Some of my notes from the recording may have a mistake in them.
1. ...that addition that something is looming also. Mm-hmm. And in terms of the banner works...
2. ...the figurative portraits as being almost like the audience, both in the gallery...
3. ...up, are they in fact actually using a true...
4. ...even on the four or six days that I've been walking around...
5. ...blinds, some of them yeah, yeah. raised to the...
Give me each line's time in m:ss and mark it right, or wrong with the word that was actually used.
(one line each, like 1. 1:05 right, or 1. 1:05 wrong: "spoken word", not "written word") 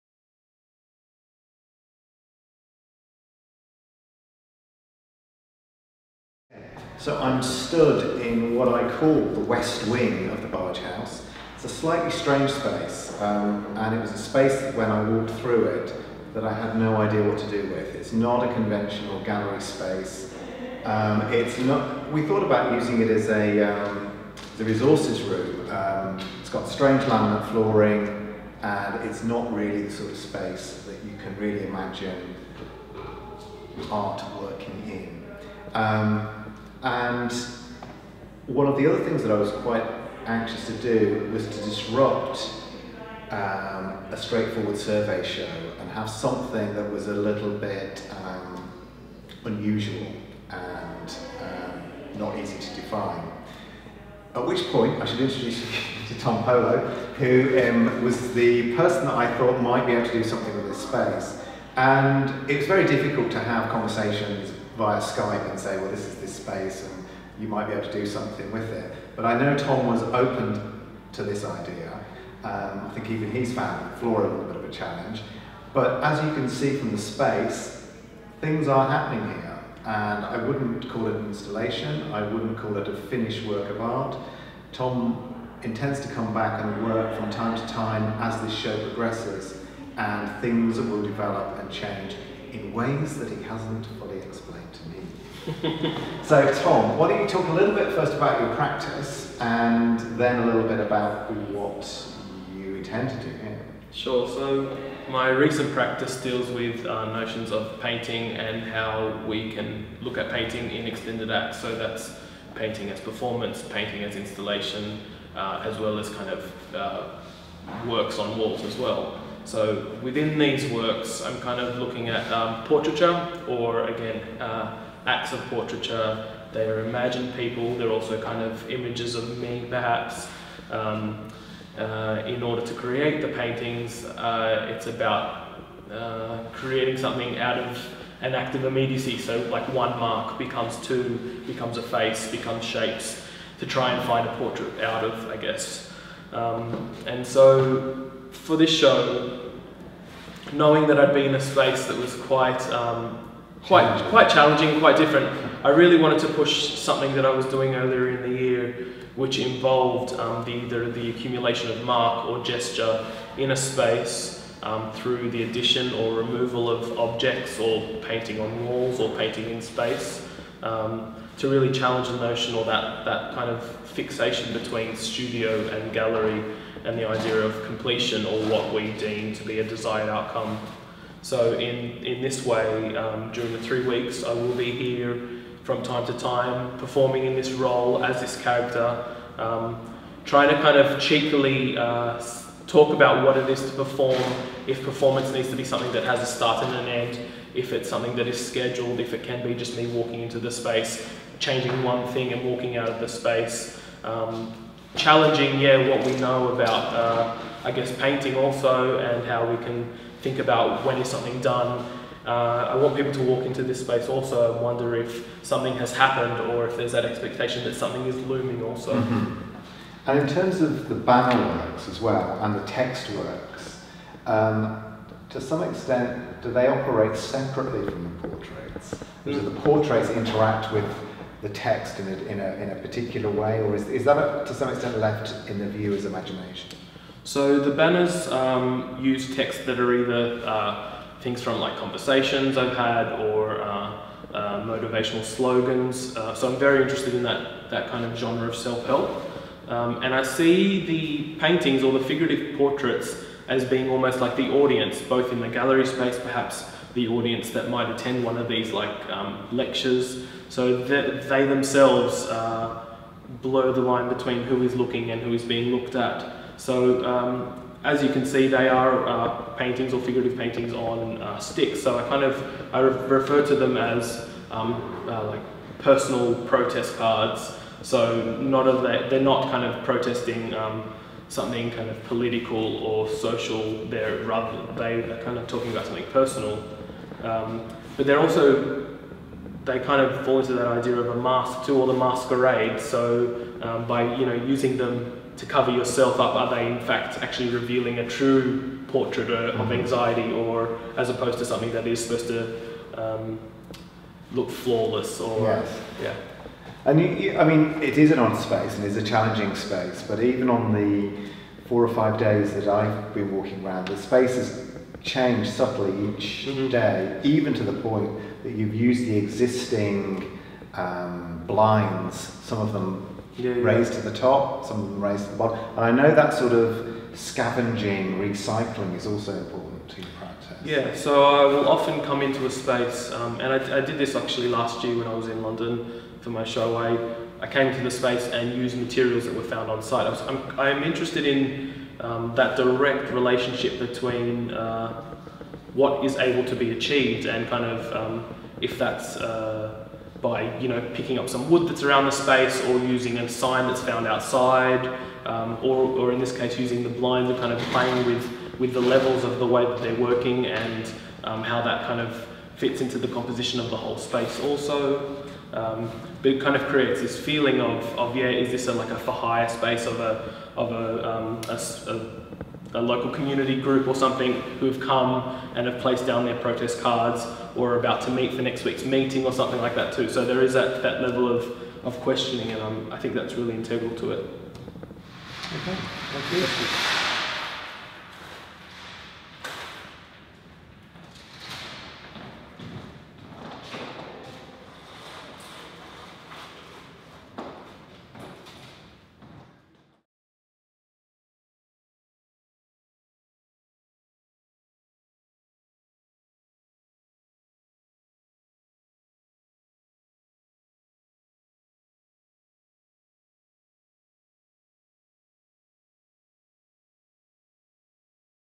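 1. 3:36 wrong: "expectation", not "addition"
2. 4:11 right
3. 4:56 wrong: "revealing", not "using"
4. 5:10 wrong: "five", not "six"
5. 5:21 right.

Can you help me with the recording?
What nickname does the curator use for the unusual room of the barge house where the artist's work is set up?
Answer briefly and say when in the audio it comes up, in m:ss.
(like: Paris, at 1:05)
west wing, at 0:09.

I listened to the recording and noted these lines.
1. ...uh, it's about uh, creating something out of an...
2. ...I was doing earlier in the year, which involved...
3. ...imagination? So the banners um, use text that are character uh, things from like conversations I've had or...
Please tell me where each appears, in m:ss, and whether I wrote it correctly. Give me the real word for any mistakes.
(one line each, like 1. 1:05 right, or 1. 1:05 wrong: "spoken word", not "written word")
1. 2:14 right
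2. 2:37 right
3. 3:56 wrong: "either", not "character".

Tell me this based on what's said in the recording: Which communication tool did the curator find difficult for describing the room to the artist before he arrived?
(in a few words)
Skype.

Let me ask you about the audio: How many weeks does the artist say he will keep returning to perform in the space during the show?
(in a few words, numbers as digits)
3.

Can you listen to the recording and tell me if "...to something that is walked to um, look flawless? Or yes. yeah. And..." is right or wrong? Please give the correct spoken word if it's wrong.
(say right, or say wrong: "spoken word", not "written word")
wrong: "supposed", not "walked".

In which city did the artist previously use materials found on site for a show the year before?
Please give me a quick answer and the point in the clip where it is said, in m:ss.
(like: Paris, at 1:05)
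London, at 5:35.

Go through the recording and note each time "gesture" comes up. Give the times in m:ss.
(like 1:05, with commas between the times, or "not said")
2:42.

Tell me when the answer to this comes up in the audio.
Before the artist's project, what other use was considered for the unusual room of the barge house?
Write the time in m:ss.
0:24.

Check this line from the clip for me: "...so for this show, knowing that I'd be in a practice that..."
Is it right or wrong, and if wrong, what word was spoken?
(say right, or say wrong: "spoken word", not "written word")
wrong: "space", not "practice".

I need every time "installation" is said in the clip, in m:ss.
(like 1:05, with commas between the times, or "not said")
1:21, 1:54.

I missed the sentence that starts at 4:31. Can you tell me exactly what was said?
So I kind of I re refer to them as um, uh, like personal protest cards.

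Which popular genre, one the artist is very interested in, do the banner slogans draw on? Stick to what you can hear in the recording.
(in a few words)
self-help.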